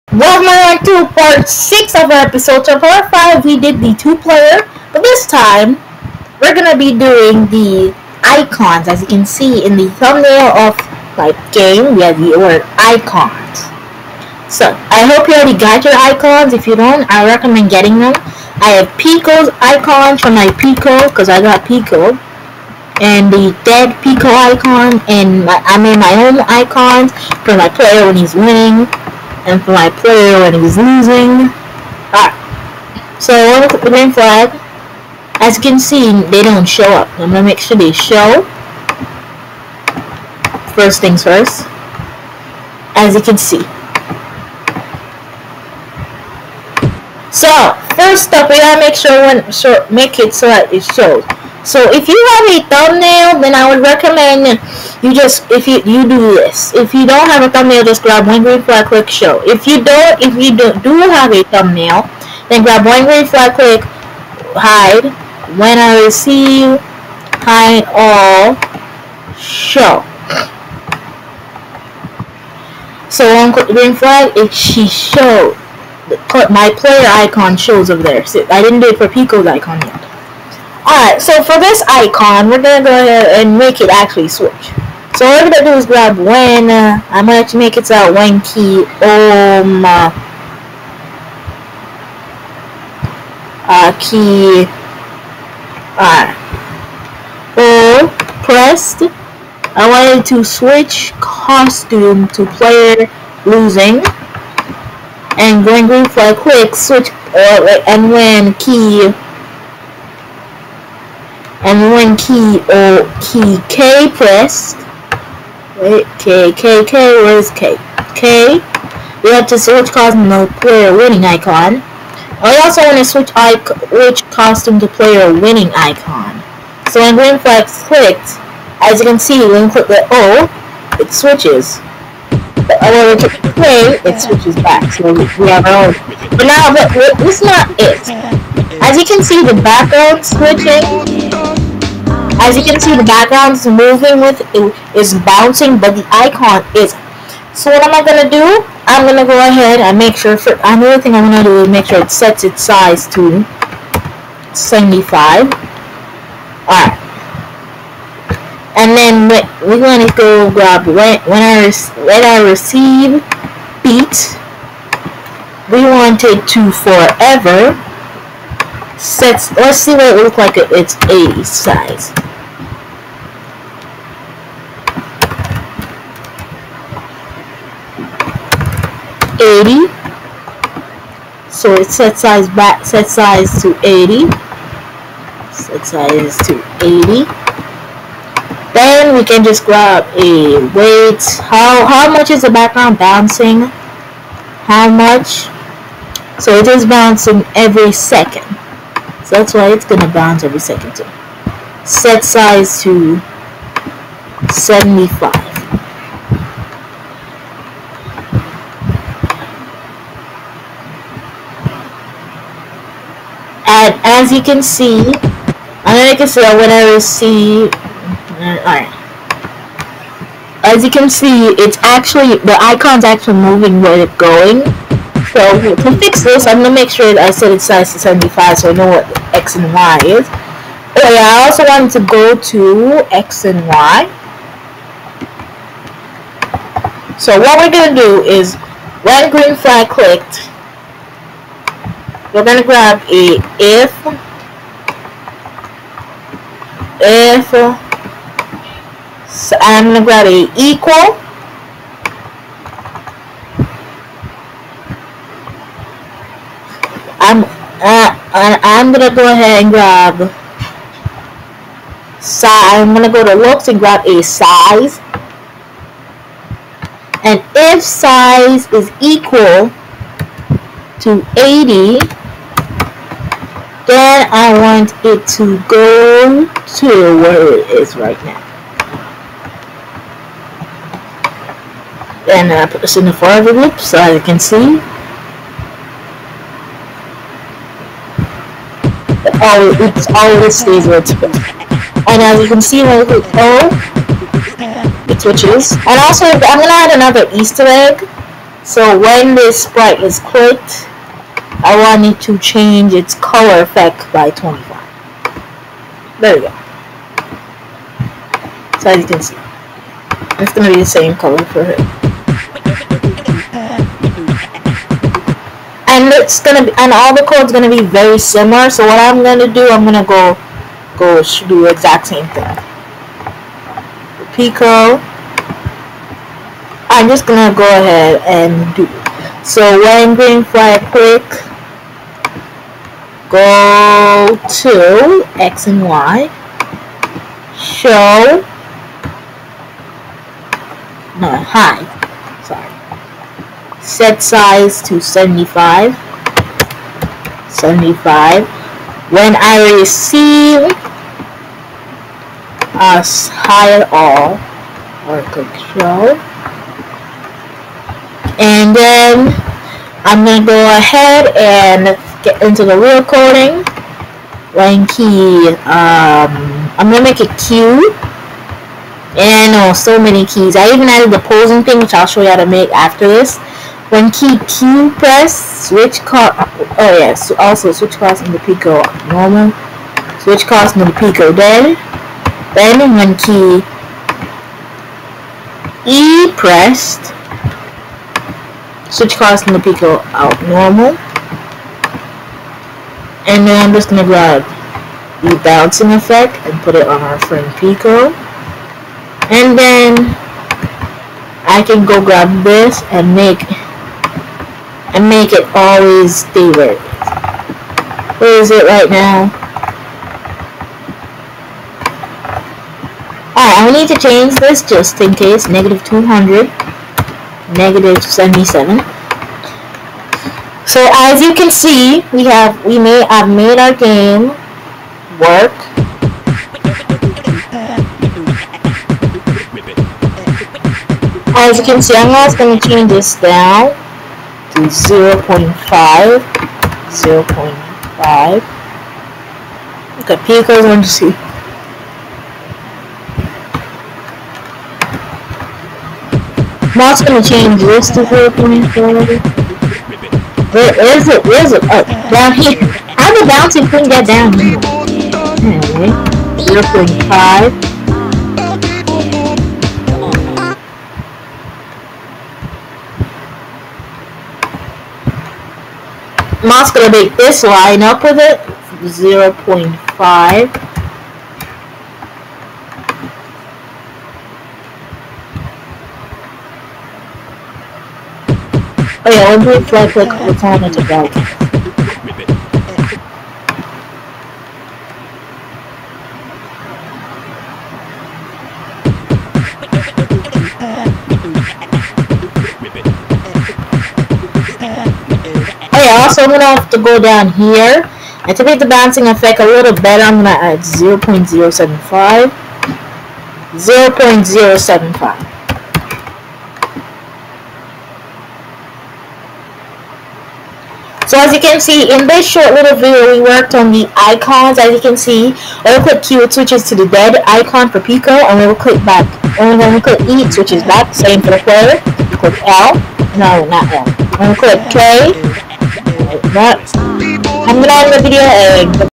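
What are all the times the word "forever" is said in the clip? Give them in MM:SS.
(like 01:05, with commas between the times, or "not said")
02:46, 04:43.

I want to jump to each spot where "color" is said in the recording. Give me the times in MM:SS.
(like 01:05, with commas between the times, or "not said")
05:03, 05:11.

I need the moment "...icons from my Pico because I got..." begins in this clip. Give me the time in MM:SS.
00:19.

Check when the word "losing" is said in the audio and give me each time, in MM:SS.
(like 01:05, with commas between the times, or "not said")
00:30, 01:43.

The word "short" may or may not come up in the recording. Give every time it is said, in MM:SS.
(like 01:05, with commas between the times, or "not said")
08:32.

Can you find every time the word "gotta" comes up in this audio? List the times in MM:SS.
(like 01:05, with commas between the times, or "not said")
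00:48.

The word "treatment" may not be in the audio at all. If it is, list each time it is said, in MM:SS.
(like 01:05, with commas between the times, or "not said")
not said.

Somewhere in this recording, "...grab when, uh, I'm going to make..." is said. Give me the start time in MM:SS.
01:25.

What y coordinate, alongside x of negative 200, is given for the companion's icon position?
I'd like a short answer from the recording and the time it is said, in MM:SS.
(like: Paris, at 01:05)
-77, at 06:57.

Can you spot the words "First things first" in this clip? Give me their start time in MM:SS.
00:40.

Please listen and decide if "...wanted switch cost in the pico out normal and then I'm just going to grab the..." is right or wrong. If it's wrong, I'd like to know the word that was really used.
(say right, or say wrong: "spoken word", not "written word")
wrong: "pressed", not "wanted".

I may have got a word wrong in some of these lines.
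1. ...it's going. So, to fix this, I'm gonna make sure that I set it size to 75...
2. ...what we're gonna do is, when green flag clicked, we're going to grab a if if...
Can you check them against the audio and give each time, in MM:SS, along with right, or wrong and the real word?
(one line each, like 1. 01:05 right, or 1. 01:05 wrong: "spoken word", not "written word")
1. 03:44 right
2. 03:57 right.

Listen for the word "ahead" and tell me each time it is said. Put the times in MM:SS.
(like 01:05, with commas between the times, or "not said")
01:22, 02:29, 04:19, 05:27, 06:00.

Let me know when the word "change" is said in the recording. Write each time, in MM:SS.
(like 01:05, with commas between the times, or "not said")
05:02, 06:53, 07:12, 07:27.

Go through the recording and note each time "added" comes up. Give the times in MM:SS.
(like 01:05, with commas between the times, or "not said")
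06:10.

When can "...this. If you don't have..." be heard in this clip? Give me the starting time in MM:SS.
00:56.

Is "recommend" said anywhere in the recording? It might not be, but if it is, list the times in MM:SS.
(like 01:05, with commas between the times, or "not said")
00:17, 00:53.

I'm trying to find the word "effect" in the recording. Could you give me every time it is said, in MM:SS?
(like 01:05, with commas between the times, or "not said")
05:03, 06:35, 08:19.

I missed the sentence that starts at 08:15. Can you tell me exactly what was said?
Oh yeah, also I'm gonna have to go down here.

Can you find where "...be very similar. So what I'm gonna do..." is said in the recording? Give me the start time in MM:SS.
05:17.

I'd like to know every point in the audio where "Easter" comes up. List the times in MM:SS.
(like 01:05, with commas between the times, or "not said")
04:57.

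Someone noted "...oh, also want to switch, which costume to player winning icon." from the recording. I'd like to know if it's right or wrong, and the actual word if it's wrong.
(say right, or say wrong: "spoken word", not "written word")
right.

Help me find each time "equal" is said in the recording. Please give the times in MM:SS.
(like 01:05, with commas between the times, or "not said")
04:10, 04:29.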